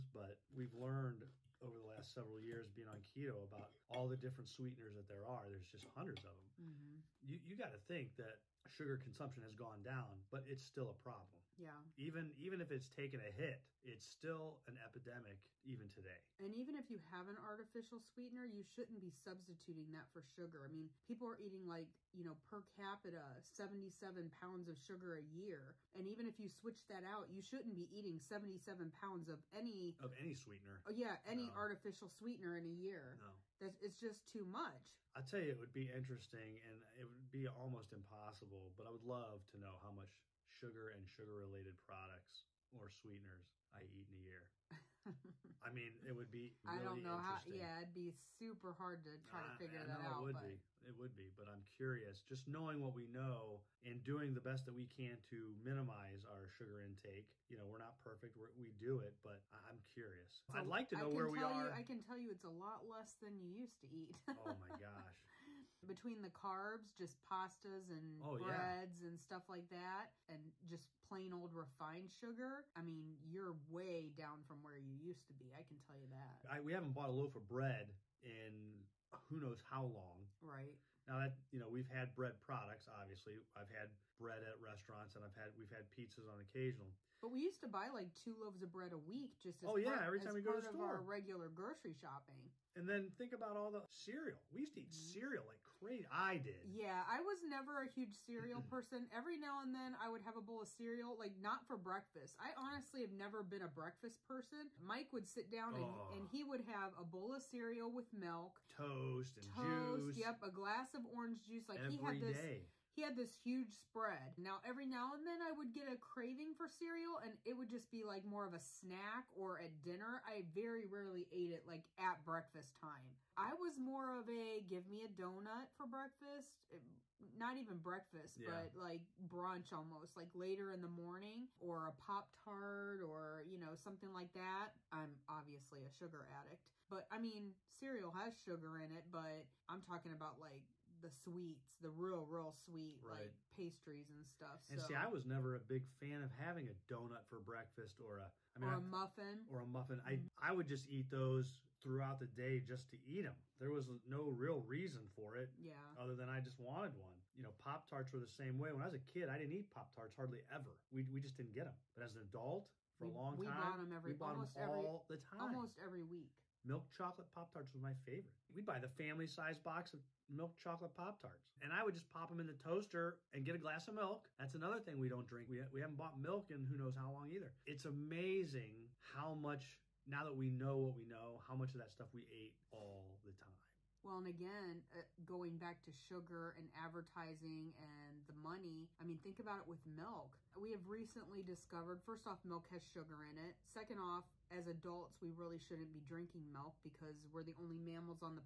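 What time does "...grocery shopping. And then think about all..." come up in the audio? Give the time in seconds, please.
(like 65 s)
91 s.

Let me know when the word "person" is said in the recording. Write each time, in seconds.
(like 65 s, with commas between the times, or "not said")
98 s, 104 s.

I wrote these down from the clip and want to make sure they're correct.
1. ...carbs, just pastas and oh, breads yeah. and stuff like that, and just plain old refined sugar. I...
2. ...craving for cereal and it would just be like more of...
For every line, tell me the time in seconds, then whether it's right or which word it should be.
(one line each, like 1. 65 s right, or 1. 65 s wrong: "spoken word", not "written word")
1. 66 s right
2. 115 s right.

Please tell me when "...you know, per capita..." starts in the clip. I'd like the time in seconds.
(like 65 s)
22 s.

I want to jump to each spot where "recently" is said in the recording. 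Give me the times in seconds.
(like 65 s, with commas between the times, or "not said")
190 s.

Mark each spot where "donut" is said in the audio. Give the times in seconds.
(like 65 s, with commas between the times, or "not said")
125 s, 146 s.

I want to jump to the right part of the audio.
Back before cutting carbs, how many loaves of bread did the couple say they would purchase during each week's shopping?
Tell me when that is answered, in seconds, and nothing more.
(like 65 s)
88 s.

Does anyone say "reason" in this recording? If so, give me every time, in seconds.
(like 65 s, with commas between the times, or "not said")
154 s.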